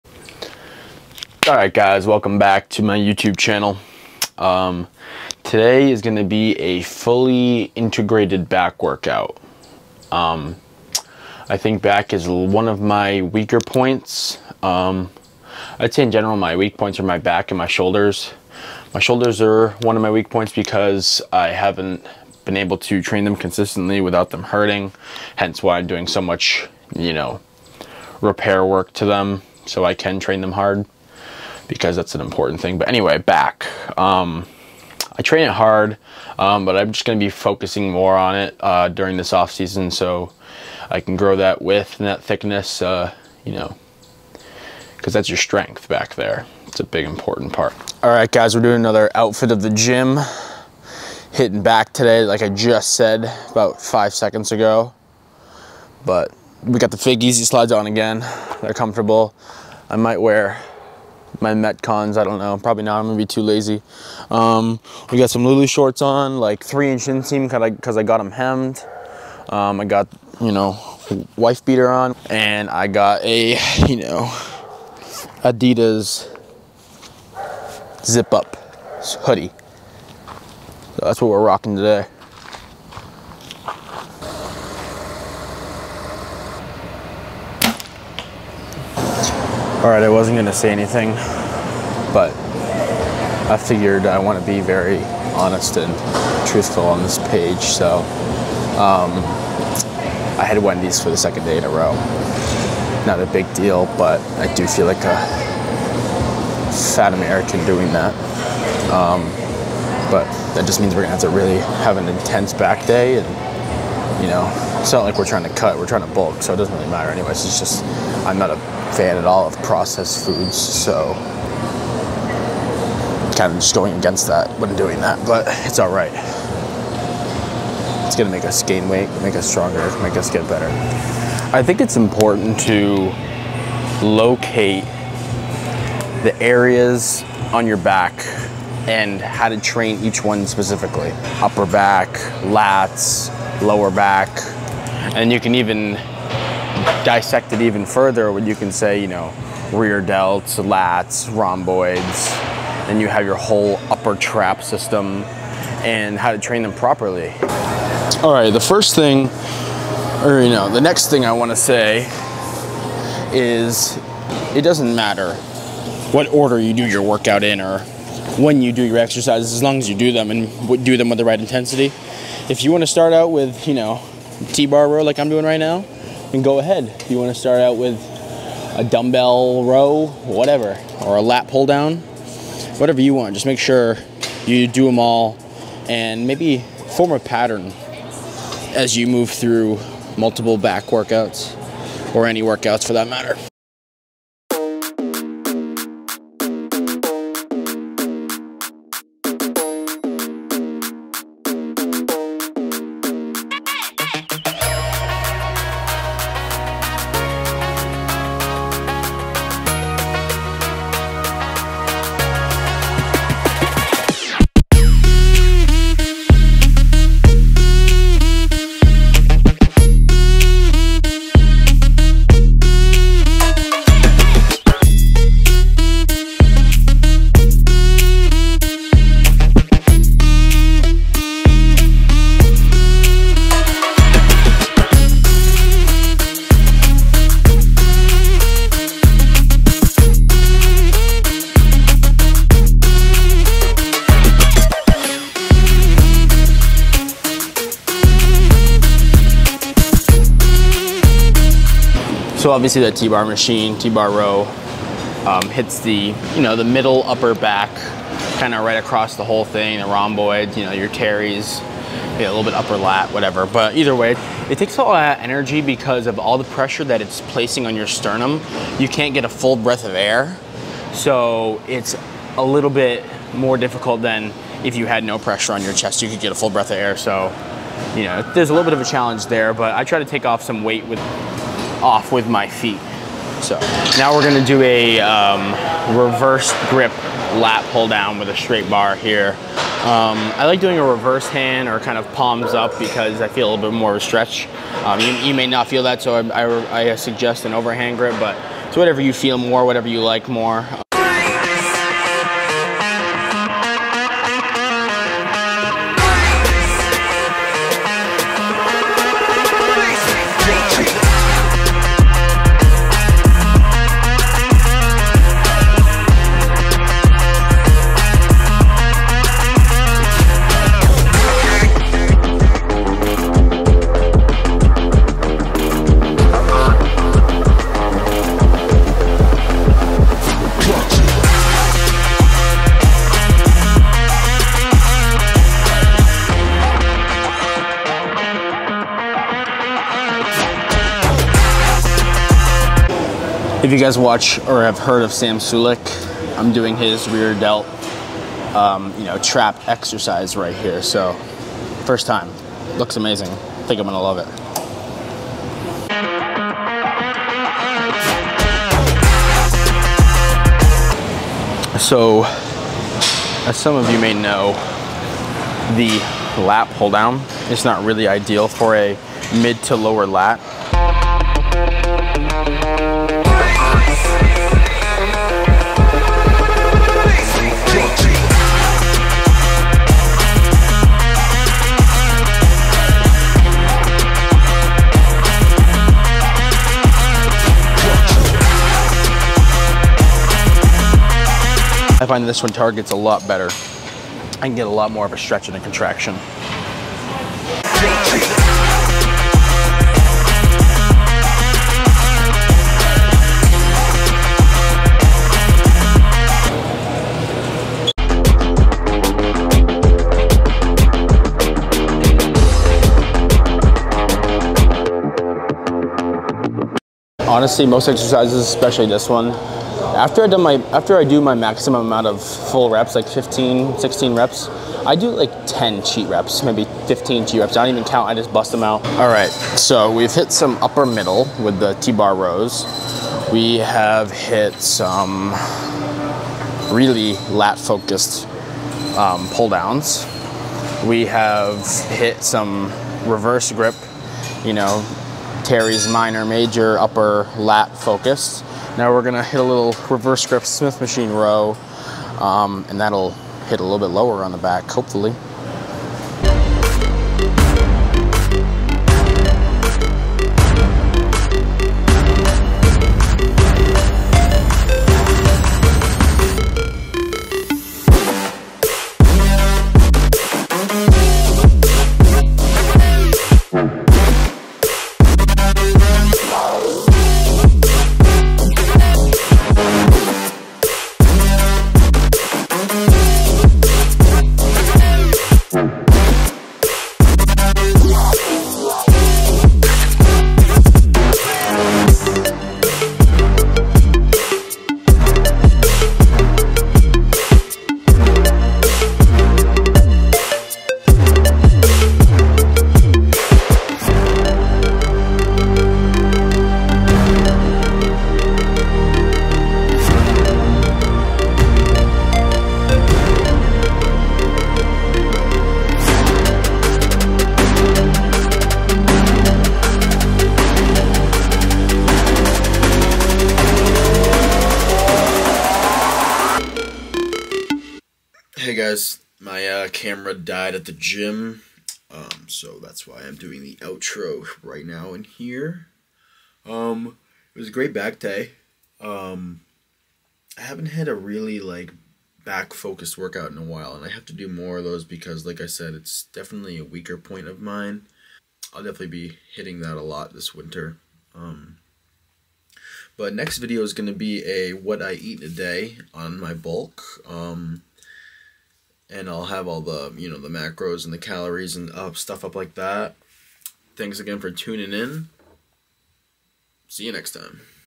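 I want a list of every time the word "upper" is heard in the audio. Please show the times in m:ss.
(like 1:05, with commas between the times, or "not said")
2:21, 2:33, 4:17, 4:22, 7:10, 7:26.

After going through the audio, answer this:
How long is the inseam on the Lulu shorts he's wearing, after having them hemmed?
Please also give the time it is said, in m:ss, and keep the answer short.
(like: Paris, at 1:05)
3 inch, at 1:06.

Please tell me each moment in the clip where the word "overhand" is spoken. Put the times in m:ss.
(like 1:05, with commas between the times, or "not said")
4:57.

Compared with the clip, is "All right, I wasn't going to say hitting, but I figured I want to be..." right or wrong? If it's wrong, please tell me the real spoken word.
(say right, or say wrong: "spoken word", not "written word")
wrong: "anything", not "hitting".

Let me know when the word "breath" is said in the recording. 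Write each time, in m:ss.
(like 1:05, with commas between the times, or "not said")
4:29, 4:36.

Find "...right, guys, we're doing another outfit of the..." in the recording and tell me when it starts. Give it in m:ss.
0:48.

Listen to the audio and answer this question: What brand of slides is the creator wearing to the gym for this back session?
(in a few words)
Fig Easy Slides.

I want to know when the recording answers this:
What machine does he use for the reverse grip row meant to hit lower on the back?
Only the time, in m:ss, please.
7:30.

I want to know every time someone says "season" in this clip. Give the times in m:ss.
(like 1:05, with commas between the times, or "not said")
0:39.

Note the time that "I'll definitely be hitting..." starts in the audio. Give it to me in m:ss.
9:08.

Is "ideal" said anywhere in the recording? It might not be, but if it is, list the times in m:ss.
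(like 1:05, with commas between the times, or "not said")
6:08.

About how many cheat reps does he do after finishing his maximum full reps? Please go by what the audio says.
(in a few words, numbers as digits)
10.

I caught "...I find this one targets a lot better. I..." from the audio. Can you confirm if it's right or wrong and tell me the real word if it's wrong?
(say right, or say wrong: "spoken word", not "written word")
right.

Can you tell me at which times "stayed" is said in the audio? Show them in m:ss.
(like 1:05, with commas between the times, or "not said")
not said.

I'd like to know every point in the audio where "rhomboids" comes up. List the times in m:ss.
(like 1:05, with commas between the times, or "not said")
2:31, 4:19.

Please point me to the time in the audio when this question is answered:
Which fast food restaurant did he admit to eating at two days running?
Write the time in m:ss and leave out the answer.
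1:40.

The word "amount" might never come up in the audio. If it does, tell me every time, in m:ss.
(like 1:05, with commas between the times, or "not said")
7:01.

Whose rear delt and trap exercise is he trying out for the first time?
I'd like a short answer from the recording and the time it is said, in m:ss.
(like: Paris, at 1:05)
Sam Sulek, at 5:45.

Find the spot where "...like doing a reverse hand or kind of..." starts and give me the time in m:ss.
4:50.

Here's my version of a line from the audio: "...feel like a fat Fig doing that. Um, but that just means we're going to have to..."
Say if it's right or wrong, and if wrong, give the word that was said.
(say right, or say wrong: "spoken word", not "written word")
wrong: "American", not "Fig".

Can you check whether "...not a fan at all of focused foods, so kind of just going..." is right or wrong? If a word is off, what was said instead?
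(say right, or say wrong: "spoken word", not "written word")
wrong: "processed", not "focused".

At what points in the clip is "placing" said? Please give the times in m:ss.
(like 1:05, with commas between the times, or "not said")
4:27.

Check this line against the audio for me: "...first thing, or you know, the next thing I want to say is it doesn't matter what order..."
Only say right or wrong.
right.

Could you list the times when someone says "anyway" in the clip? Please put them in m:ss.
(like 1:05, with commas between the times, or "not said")
0:32, 1:57.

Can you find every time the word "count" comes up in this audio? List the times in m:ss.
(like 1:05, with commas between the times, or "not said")
7:07.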